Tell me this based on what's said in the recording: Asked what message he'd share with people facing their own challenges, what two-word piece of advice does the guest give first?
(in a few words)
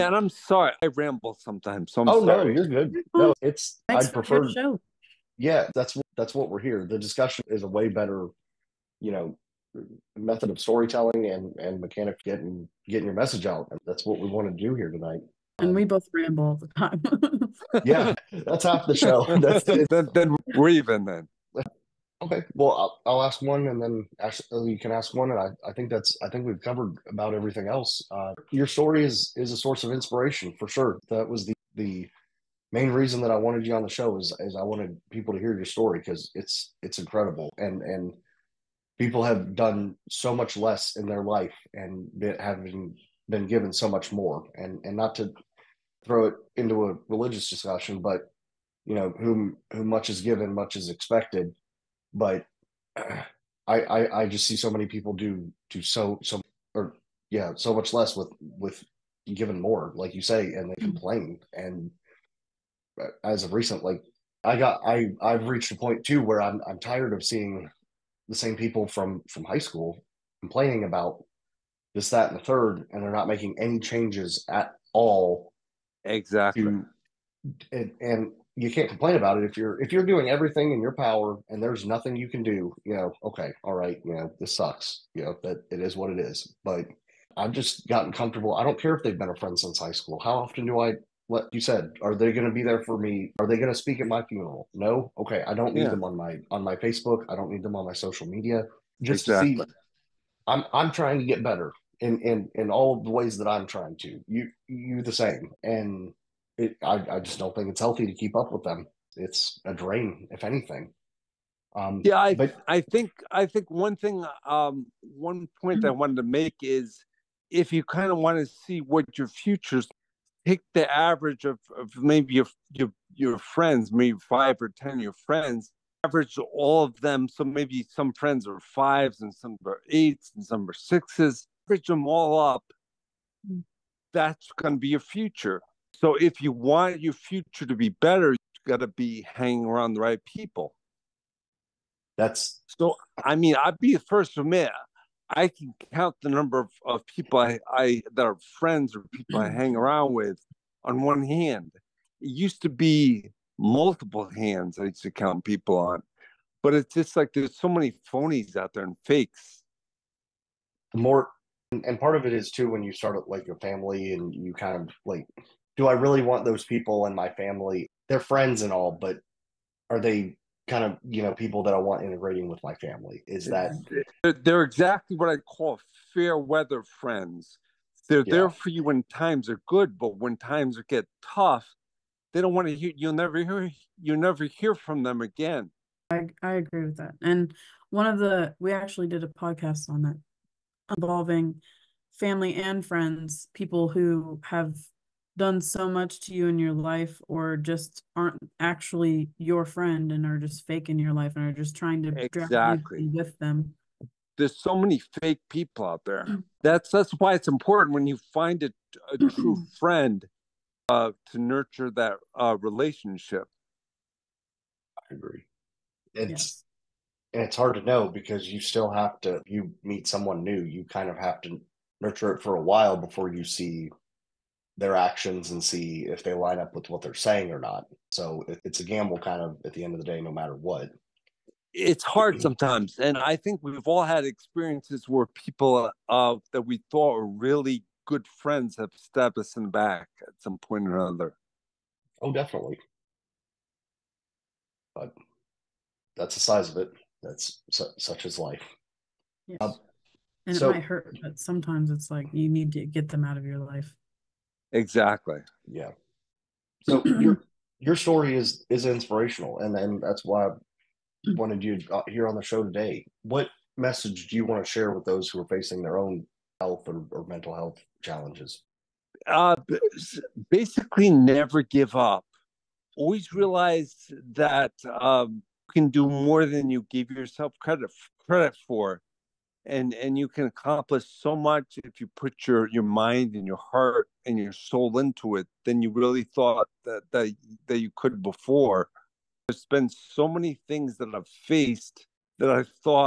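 never give up.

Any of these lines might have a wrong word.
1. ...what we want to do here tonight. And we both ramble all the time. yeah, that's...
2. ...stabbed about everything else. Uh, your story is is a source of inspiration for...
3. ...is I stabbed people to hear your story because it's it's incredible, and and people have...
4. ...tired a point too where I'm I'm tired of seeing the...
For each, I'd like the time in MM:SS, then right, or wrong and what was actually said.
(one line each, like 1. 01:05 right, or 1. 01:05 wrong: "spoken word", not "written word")
1. 00:14 right
2. 00:26 wrong: "covered", not "stabbed"
3. 00:34 wrong: "wanted", not "stabbed"
4. 01:05 wrong: "reached", not "tired".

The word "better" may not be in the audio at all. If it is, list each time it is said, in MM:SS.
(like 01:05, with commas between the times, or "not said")
00:07, 01:41, 02:17.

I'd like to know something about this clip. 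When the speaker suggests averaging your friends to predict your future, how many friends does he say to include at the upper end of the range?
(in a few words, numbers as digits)
10.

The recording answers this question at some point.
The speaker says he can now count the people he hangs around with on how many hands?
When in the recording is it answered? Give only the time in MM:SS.
02:31.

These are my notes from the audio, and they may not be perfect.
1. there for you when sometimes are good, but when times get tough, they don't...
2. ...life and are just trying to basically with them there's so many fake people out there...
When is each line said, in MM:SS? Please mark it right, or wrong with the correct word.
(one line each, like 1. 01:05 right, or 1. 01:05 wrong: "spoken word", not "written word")
1. 02:58 wrong: "times", not "sometimes"
2. 03:21 wrong: "exactly", not "basically".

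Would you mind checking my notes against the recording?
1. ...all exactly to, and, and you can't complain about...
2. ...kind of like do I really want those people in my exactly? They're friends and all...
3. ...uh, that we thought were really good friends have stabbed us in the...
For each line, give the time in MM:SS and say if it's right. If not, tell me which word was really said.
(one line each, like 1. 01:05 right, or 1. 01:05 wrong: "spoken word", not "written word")
1. 01:14 right
2. 02:44 wrong: "family", not "exactly"
3. 03:56 right.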